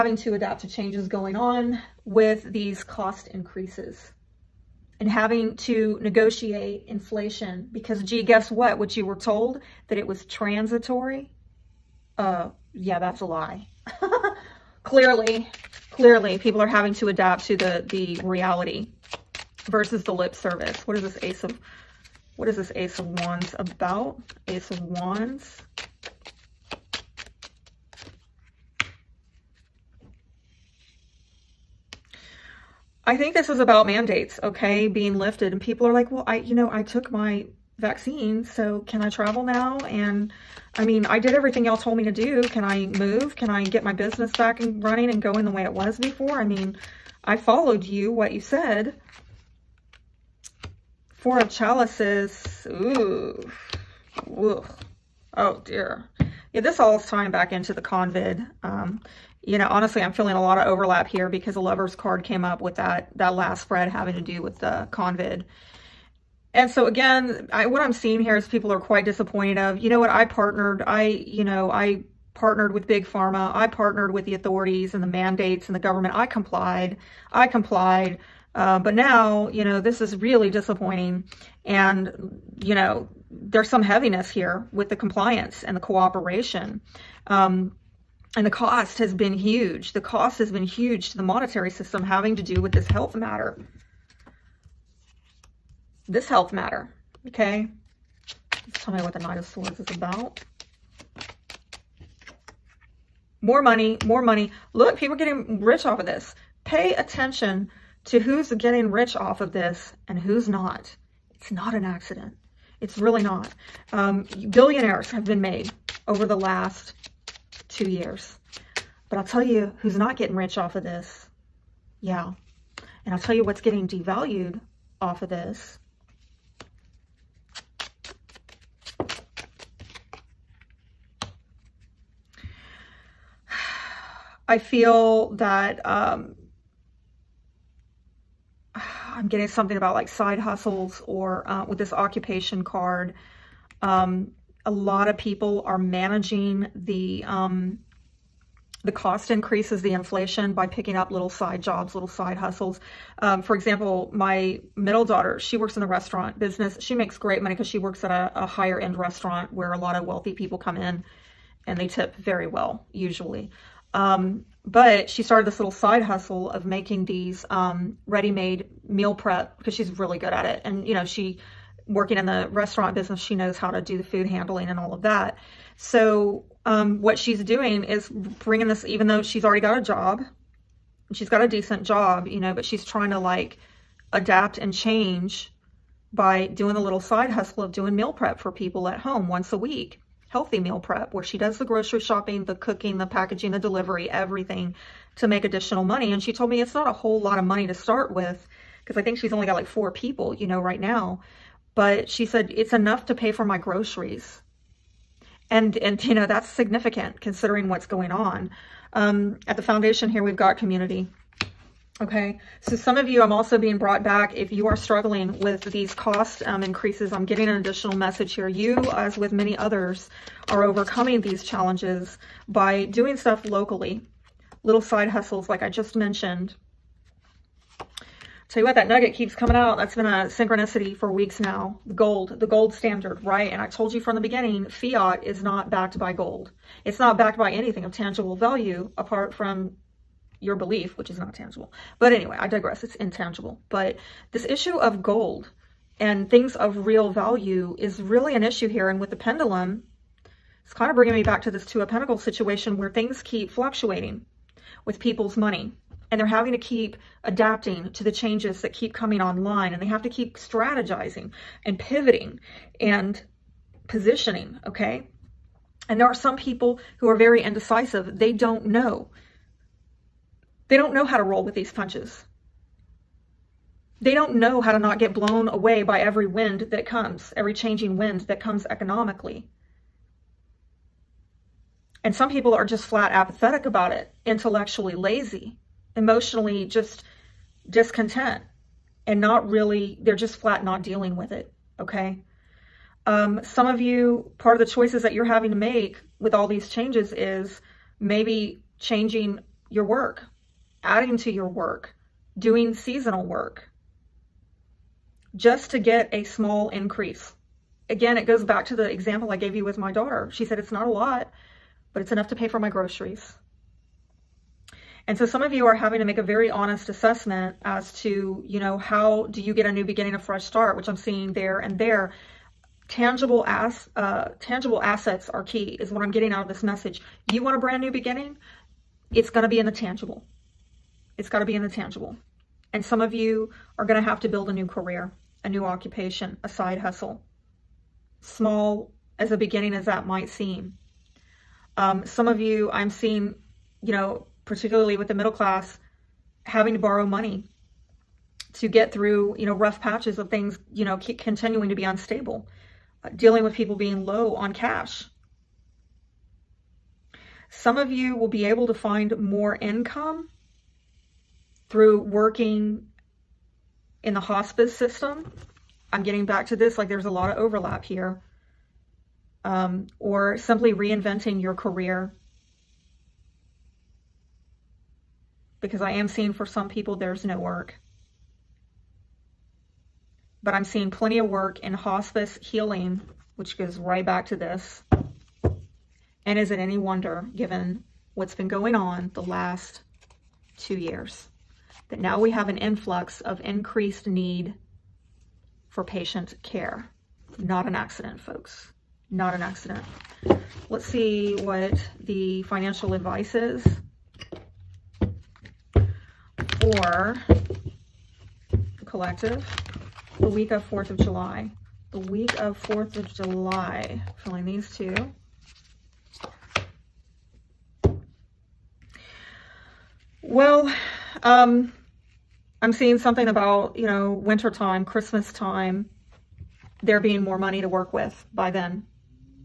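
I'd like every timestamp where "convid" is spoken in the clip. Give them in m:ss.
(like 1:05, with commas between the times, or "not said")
0:57, 1:04.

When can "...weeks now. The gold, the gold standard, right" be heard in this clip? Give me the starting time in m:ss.
3:51.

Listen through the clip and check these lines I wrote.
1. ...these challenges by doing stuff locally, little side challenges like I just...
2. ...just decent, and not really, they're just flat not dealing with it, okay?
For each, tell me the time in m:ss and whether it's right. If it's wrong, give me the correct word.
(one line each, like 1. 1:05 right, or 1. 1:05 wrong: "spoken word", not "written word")
1. 3:41 wrong: "hustles", not "challenges"
2. 4:46 wrong: "discontent", not "decent".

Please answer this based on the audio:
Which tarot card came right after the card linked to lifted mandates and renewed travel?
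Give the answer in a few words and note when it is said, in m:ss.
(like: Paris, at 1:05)
Four of Chalices, at 0:51.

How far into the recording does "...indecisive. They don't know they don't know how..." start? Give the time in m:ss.
4:27.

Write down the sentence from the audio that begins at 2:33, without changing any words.
Um, for example, my middle daughter, she works in the restaurant business.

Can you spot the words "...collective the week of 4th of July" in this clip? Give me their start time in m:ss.
6:48.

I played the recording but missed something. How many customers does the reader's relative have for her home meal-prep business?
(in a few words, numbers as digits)
4.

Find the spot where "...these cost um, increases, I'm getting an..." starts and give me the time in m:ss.
3:35.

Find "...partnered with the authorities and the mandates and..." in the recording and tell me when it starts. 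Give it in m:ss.
1:13.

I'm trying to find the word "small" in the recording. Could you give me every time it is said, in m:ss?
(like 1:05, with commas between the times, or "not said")
5:06, 5:38.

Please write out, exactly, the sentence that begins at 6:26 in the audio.
And is it any wonder given what's been going on the last two years?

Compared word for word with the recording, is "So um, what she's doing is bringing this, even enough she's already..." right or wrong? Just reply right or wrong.
wrong.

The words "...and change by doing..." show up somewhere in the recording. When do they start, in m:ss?
3:04.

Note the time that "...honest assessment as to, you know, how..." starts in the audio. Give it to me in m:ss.
5:16.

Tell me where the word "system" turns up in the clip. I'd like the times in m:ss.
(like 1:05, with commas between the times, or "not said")
1:31, 6:04.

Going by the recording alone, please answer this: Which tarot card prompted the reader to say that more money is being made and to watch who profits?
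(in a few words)
Knight of Swords.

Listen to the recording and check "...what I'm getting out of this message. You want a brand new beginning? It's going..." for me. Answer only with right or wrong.
right.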